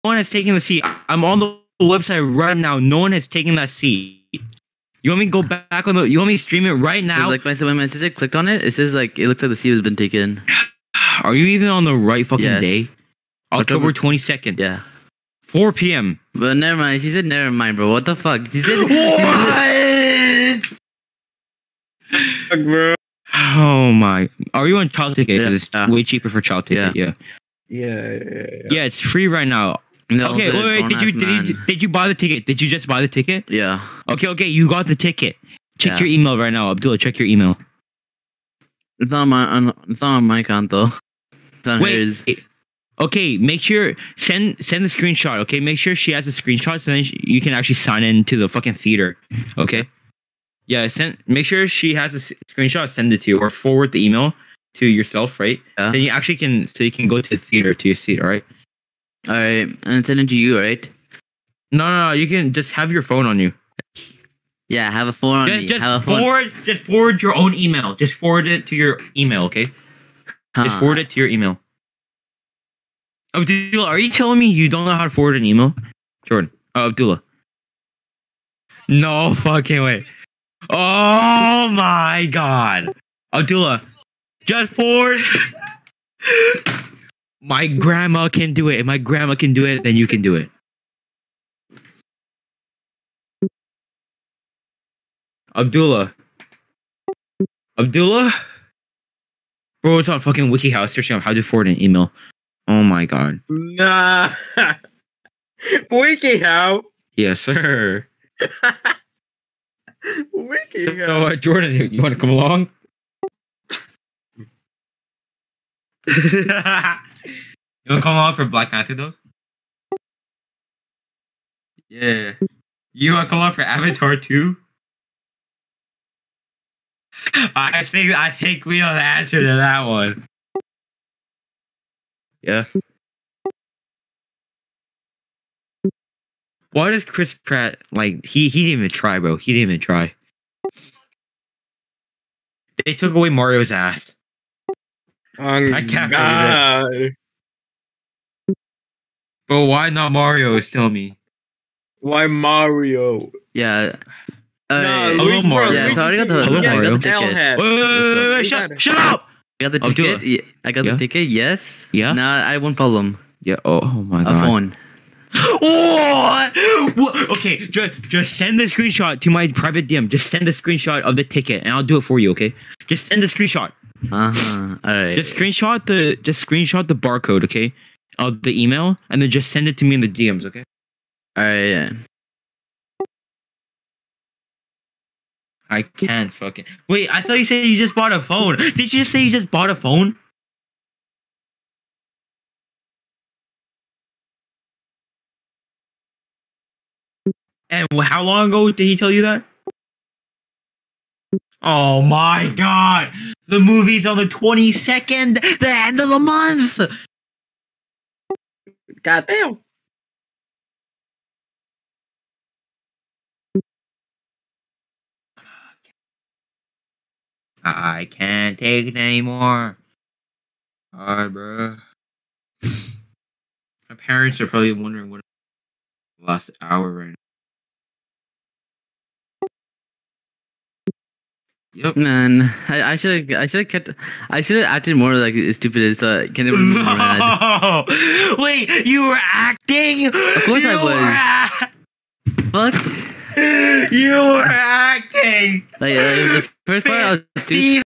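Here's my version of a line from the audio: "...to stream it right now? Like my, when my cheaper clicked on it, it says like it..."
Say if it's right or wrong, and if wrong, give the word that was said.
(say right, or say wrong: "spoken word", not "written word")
wrong: "sister", not "cheaper".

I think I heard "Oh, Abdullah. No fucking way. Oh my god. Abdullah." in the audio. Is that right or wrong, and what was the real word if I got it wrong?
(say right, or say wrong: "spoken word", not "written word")
right.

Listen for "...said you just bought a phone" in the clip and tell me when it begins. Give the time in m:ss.
3:07.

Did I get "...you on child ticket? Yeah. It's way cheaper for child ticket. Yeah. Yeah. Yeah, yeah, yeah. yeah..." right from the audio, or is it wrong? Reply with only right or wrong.
right.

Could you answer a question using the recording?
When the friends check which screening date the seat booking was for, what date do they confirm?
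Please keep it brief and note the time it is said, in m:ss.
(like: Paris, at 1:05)
October 22, at 0:13.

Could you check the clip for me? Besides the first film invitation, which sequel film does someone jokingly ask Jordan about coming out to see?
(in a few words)
Avatar 2.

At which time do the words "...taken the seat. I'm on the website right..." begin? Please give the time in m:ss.
0:00.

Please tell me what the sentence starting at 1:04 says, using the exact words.
Yeah, have a phone on just, me.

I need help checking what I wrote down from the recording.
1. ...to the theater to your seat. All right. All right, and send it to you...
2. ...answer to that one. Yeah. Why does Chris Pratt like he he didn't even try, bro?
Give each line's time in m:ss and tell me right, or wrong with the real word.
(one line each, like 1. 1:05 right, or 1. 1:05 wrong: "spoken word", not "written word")
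1. 0:57 right
2. 2:08 right.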